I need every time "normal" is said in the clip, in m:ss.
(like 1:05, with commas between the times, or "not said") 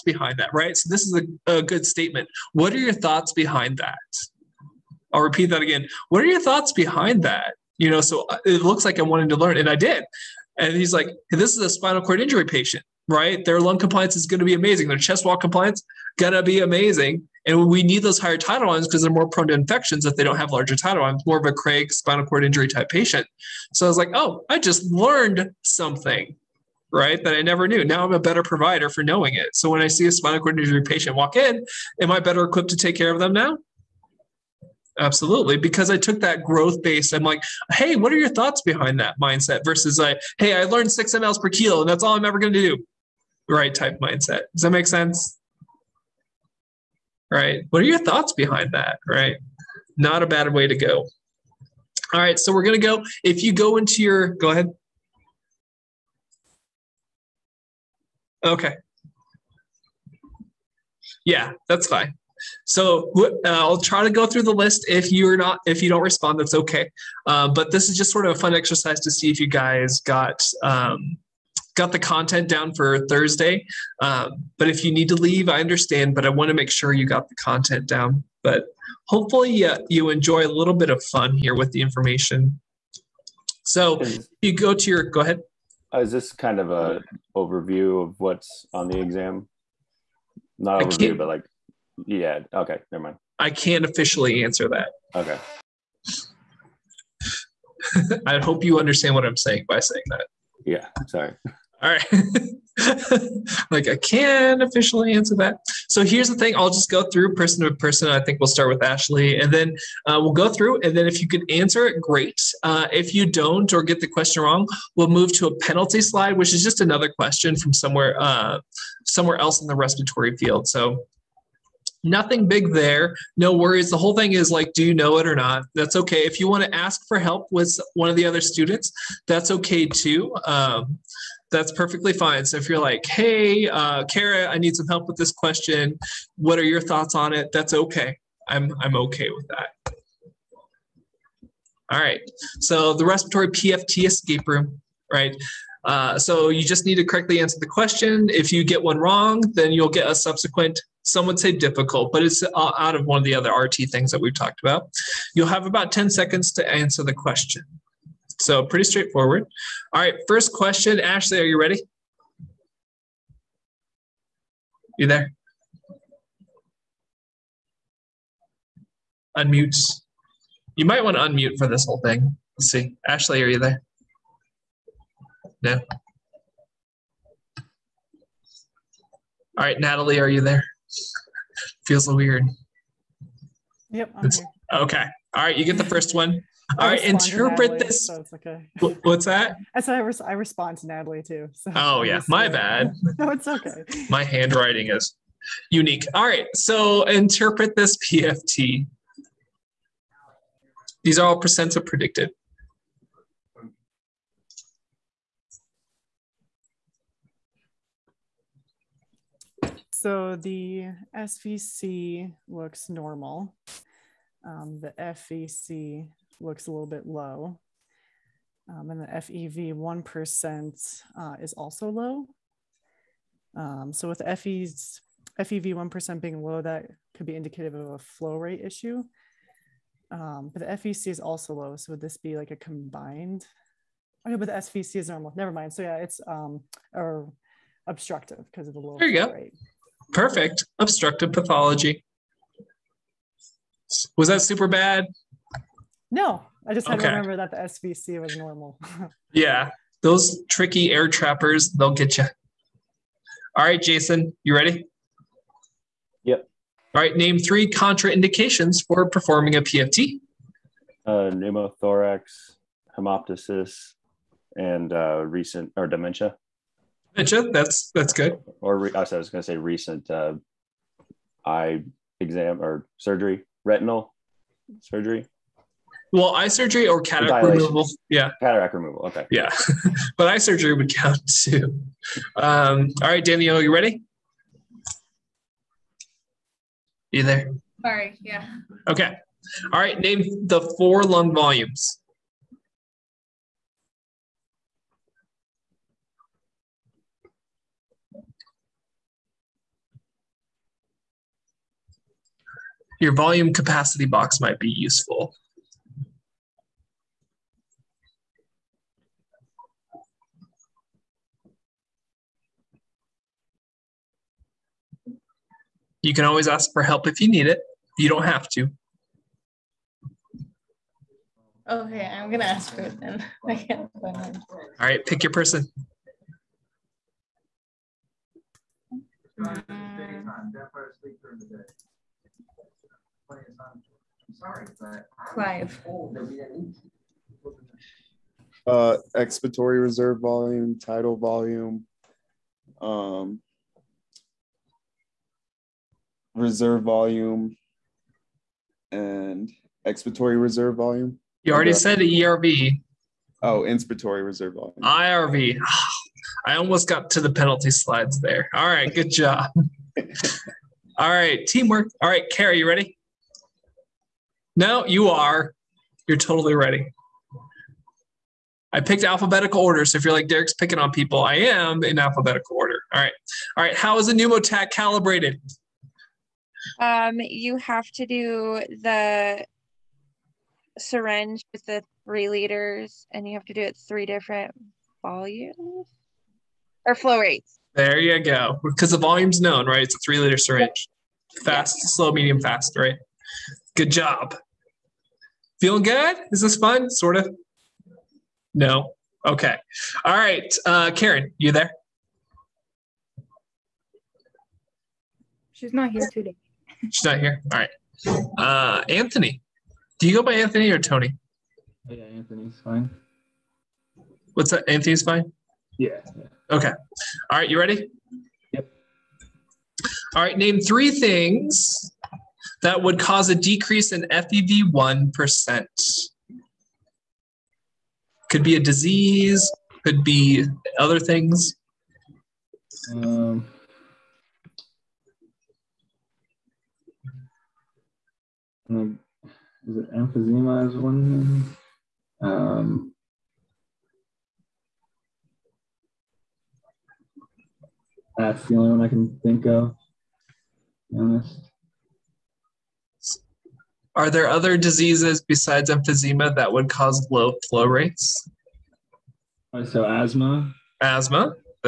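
3:32, 3:55, 4:08.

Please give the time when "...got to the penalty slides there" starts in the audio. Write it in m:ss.
5:56.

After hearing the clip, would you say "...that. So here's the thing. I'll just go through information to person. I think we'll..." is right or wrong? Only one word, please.
wrong.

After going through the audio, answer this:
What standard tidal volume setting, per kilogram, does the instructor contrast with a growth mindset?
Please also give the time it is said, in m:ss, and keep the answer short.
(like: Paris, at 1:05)
6 mL per kilo, at 0:40.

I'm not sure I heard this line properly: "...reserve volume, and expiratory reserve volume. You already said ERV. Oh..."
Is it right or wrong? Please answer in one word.
right.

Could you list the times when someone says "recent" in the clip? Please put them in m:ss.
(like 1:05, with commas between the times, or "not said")
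4:25, 4:29.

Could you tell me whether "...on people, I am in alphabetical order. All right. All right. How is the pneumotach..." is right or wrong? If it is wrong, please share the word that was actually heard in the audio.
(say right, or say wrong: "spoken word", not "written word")
right.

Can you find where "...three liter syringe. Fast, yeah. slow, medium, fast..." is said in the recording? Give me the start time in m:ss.
6:30.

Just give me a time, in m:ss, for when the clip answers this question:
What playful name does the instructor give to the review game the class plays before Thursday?
2:23.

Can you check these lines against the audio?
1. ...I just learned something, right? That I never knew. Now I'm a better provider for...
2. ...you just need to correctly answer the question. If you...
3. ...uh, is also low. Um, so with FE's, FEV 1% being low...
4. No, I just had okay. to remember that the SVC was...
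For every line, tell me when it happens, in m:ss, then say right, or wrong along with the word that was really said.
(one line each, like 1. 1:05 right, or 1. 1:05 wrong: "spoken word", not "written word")
1. 0:24 right
2. 2:26 right
3. 3:41 right
4. 4:06 right.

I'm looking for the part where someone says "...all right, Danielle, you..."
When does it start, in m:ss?
4:43.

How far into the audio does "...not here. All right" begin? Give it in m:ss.
6:47.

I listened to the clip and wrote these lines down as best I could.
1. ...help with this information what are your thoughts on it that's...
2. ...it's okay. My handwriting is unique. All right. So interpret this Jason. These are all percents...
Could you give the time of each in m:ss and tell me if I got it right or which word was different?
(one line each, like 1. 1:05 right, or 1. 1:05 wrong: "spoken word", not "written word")
1. 2:14 wrong: "question", not "information"
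2. 3:13 wrong: "PFT", not "Jason".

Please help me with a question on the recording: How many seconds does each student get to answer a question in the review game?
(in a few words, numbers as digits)
10.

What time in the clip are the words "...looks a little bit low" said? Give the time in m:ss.
3:36.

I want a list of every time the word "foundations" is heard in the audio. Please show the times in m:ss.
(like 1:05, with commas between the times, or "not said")
not said.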